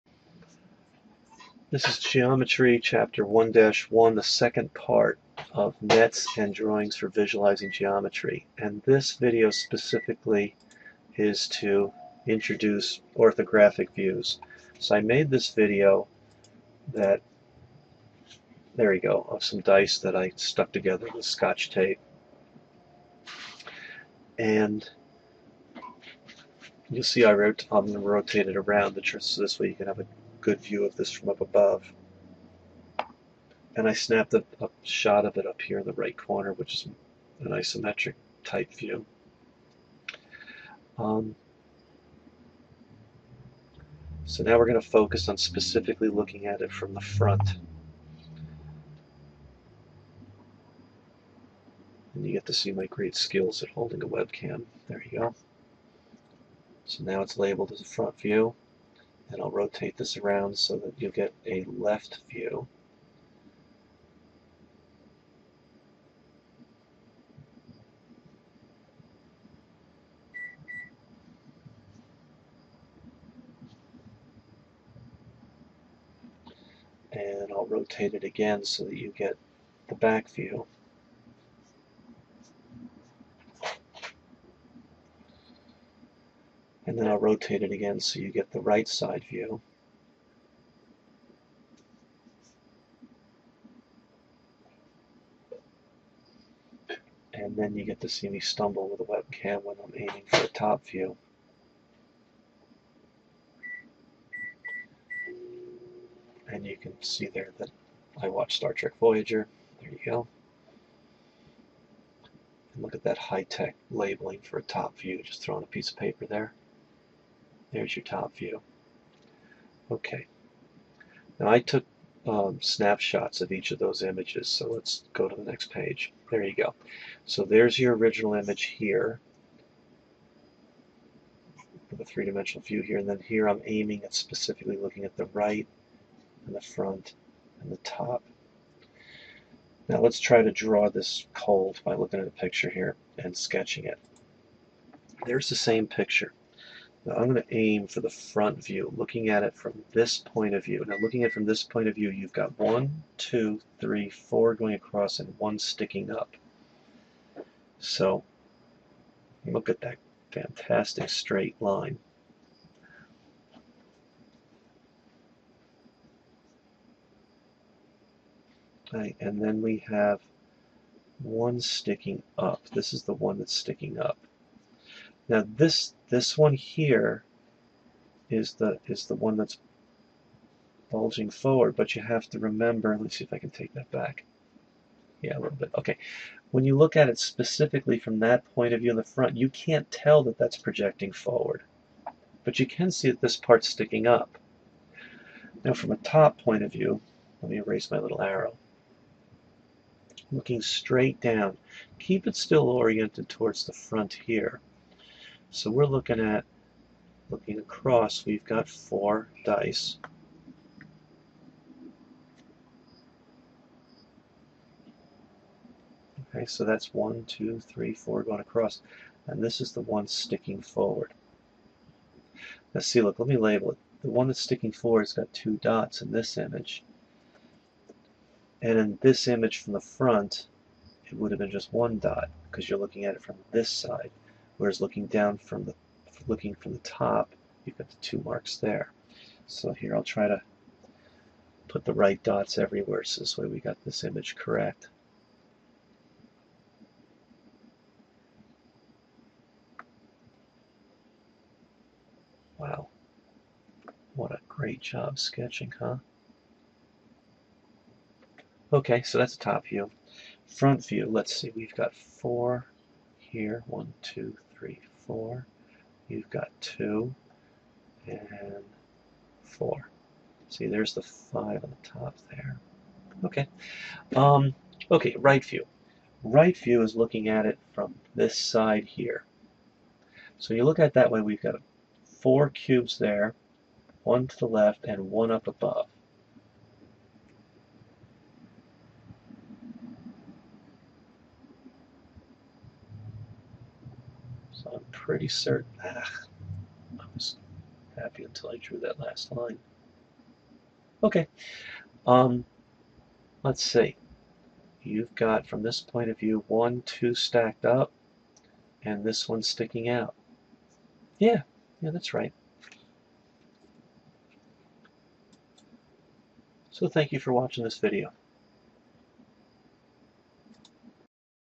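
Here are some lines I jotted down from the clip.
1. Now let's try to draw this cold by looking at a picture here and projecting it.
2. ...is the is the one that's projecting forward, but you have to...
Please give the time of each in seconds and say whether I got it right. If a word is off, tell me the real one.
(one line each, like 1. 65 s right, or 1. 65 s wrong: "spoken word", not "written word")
1. 139 s wrong: "sketching", not "projecting"
2. 178 s wrong: "bulging", not "projecting".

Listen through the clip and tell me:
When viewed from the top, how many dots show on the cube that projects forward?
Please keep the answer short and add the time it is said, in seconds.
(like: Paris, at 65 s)
2, at 225 s.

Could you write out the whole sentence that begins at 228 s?
And in this image from the front, it would have been just one dot because you're looking at it from this side.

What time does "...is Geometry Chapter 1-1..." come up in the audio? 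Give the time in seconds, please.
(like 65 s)
1 s.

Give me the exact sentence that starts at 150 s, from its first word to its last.
Now looking at it from this point of view, you've got one, two, three, four going across and one sticking up.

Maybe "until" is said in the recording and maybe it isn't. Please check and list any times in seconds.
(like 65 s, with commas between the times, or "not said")
298 s.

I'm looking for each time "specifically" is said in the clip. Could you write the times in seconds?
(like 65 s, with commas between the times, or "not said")
9 s, 45 s, 134 s, 187 s.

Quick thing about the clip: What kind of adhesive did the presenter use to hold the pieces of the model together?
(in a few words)
Scotch tape.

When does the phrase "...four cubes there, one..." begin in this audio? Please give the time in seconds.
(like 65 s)
282 s.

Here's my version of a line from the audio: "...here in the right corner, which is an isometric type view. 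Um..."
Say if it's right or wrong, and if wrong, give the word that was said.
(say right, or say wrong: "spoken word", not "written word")
right.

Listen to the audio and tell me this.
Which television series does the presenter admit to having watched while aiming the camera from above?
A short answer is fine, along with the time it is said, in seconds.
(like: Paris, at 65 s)
Star Trek Voyager, at 108 s.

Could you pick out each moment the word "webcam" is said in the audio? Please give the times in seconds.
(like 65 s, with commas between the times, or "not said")
54 s, 99 s.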